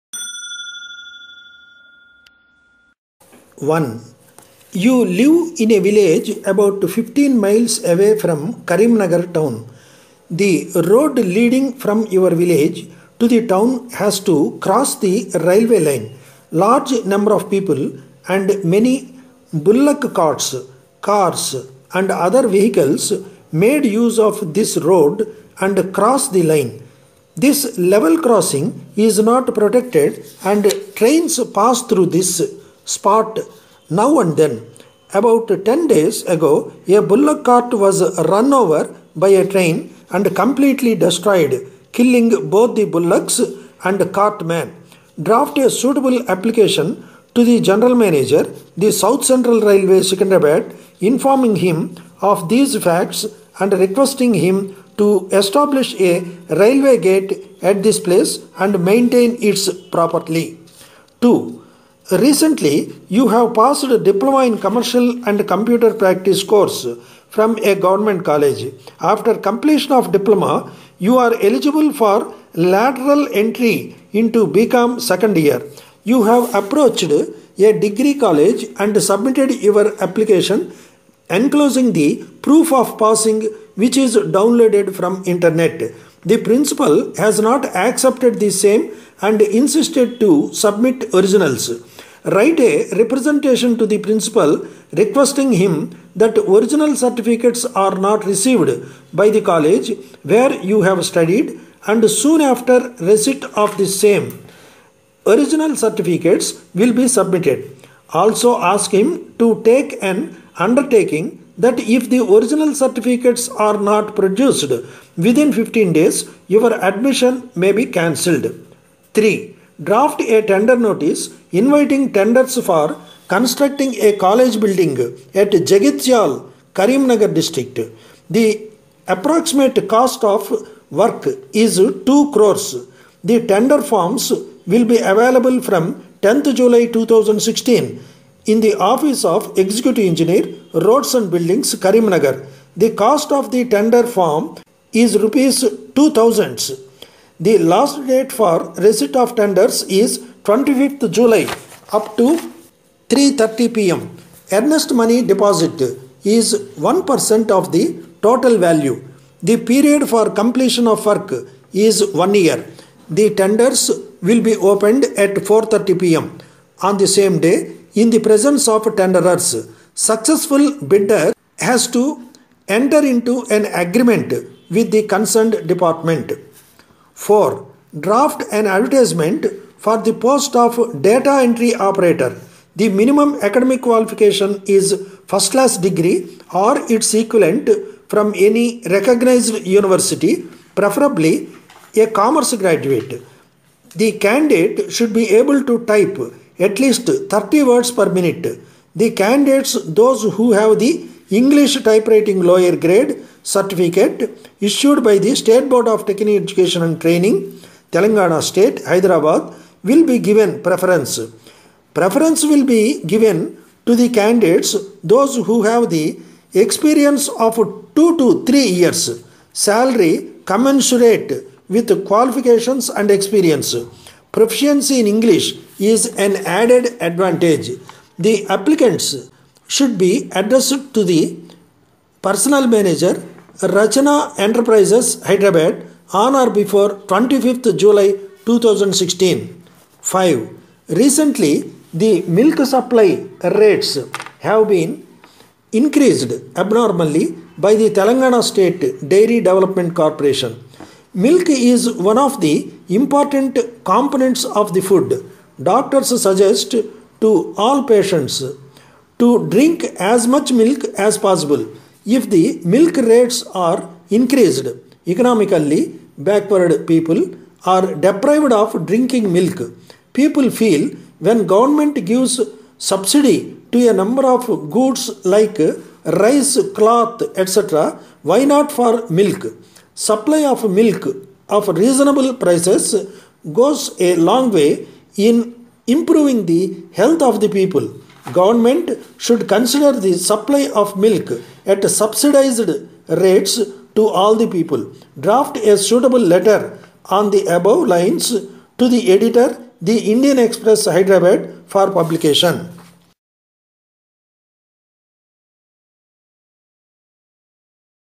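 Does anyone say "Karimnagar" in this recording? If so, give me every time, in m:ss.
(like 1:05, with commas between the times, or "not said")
0:08, 2:06, 2:21.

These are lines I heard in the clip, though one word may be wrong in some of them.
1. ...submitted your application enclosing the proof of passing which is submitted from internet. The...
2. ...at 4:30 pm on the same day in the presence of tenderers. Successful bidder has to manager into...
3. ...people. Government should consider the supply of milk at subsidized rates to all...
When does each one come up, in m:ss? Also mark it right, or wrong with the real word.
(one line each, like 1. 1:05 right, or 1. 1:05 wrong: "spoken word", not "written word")
1. 1:19 wrong: "downloaded", not "submitted"
2. 2:45 wrong: "enter", not "manager"
3. 4:47 right.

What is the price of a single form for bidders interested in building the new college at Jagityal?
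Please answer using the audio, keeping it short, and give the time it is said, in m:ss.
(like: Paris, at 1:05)
Rs 2000, at 2:25.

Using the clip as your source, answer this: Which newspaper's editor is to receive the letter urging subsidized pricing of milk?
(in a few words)
The Indian Express.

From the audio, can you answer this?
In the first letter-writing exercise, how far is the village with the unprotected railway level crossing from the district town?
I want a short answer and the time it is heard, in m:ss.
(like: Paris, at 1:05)
15 miles, at 0:06.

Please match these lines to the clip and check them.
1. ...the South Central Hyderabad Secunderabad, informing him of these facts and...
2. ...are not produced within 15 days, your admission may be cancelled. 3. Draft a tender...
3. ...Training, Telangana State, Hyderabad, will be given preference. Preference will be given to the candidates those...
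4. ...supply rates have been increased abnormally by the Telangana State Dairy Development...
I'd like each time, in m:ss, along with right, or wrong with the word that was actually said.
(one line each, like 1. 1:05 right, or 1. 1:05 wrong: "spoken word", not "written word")
1. 0:48 wrong: "Railway", not "Hyderabad"
2. 1:53 right
3. 3:27 right
4. 4:02 right.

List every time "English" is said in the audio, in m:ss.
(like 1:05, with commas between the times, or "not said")
3:21, 3:45.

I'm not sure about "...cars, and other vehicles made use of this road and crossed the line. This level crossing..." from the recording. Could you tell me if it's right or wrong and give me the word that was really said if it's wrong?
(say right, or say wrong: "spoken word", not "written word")
right.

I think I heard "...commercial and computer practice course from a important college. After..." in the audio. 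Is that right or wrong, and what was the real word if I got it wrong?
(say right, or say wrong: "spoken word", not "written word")
wrong: "government", not "important".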